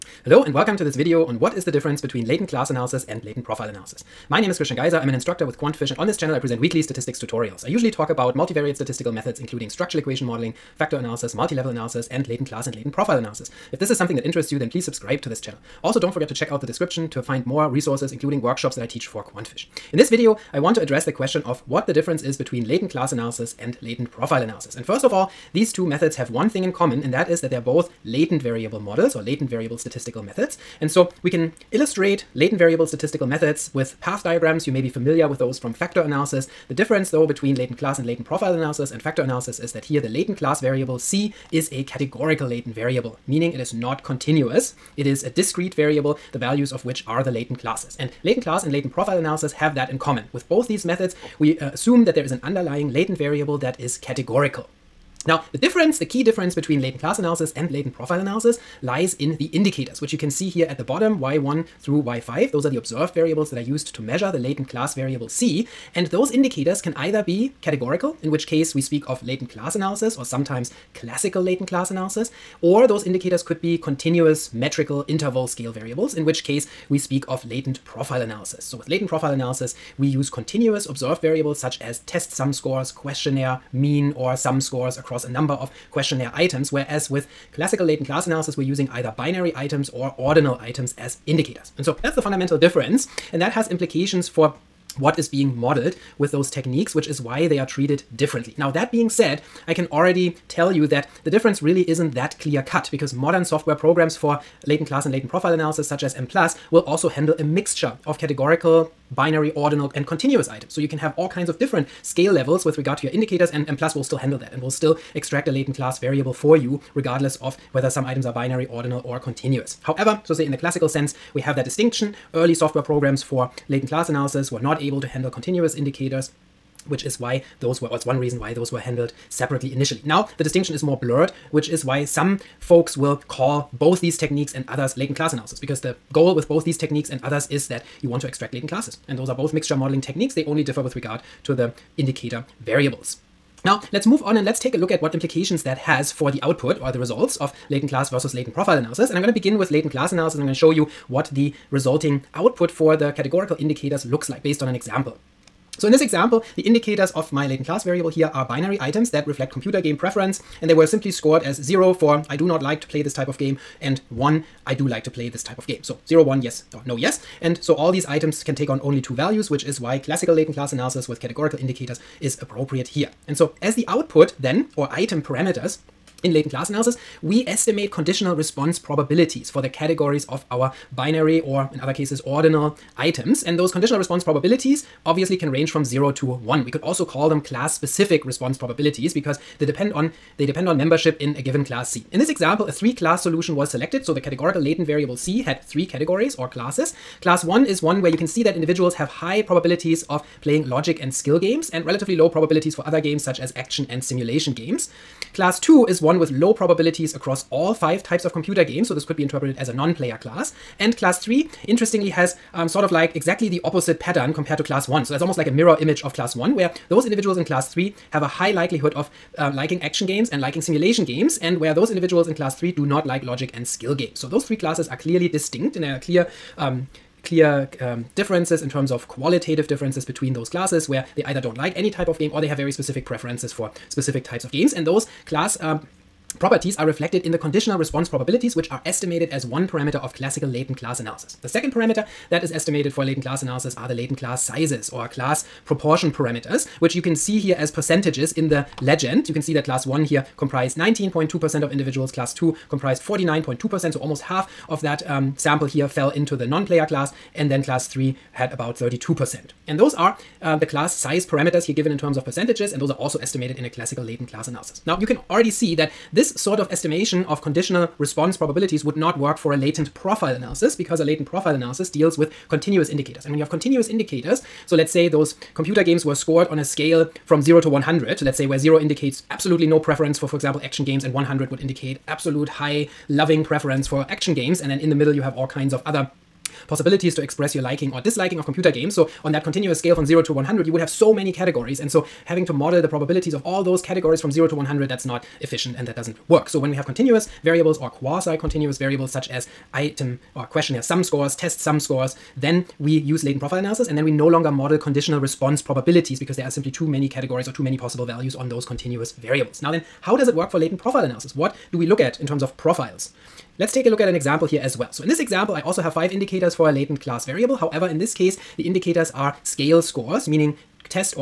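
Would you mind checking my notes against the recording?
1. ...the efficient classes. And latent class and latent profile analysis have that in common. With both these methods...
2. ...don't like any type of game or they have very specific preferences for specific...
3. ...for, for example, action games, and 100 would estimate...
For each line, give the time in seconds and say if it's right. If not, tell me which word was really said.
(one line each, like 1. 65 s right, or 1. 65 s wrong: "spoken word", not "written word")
1. 47 s wrong: "latent", not "efficient"
2. 231 s right
3. 280 s wrong: "indicate", not "estimate".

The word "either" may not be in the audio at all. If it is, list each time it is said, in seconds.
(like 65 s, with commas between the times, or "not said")
66 s, 88 s, 231 s.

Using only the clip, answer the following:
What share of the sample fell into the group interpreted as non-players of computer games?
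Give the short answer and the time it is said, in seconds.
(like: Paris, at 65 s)
49.2%, at 252 s.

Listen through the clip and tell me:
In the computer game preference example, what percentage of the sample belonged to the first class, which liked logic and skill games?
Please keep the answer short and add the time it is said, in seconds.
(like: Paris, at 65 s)
19.2%, at 250 s.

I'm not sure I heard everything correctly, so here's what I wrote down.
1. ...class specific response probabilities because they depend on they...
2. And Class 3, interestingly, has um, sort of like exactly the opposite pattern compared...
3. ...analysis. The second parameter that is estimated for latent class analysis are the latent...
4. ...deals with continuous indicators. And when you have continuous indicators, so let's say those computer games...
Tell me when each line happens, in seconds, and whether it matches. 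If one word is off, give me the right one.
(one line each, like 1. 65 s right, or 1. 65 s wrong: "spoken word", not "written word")
1. 187 s right
2. 210 s right
3. 240 s right
4. 271 s right.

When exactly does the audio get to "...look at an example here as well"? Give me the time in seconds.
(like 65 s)
313 s.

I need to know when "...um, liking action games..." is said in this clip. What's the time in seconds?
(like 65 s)
219 s.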